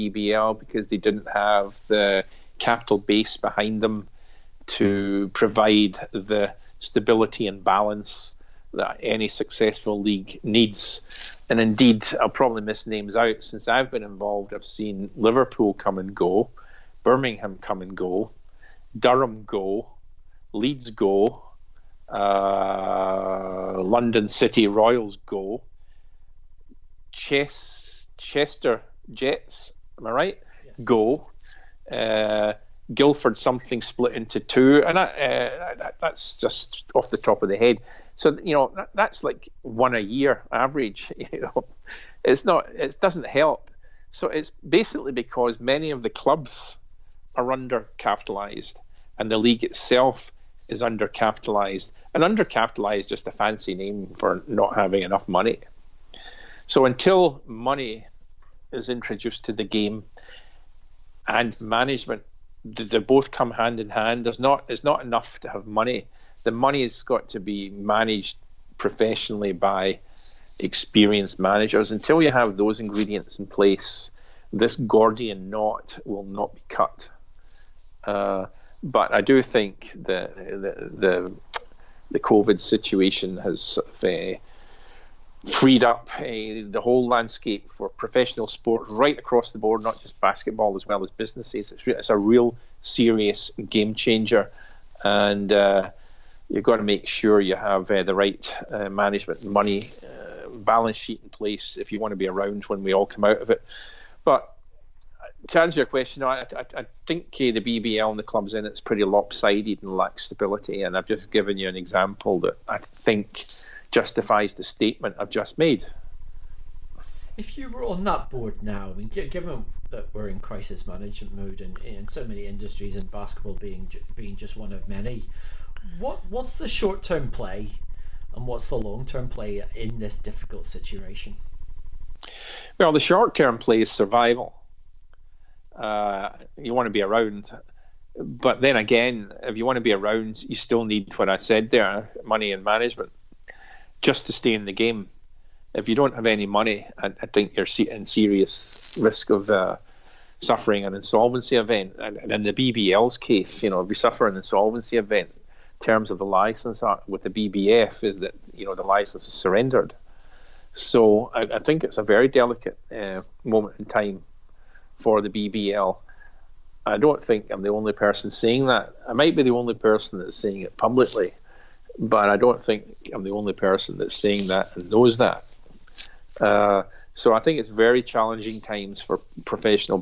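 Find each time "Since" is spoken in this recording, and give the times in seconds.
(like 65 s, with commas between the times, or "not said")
13 s.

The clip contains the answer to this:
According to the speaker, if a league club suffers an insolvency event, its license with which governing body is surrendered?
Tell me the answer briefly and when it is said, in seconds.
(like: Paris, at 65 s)
BBF, at 157 s.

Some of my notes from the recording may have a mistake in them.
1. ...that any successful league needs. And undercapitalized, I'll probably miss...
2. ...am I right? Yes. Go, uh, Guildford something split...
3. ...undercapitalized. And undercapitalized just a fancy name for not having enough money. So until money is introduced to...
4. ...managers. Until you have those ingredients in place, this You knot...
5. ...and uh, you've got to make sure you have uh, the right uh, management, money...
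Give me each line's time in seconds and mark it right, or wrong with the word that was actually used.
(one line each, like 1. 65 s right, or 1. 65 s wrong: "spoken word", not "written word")
1. 8 s wrong: "indeed", not "undercapitalized"
2. 29 s right
3. 50 s right
4. 71 s wrong: "Gordian", not "You"
5. 95 s right.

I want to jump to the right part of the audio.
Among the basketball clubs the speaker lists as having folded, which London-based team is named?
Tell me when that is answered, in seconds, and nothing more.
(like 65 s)
23 s.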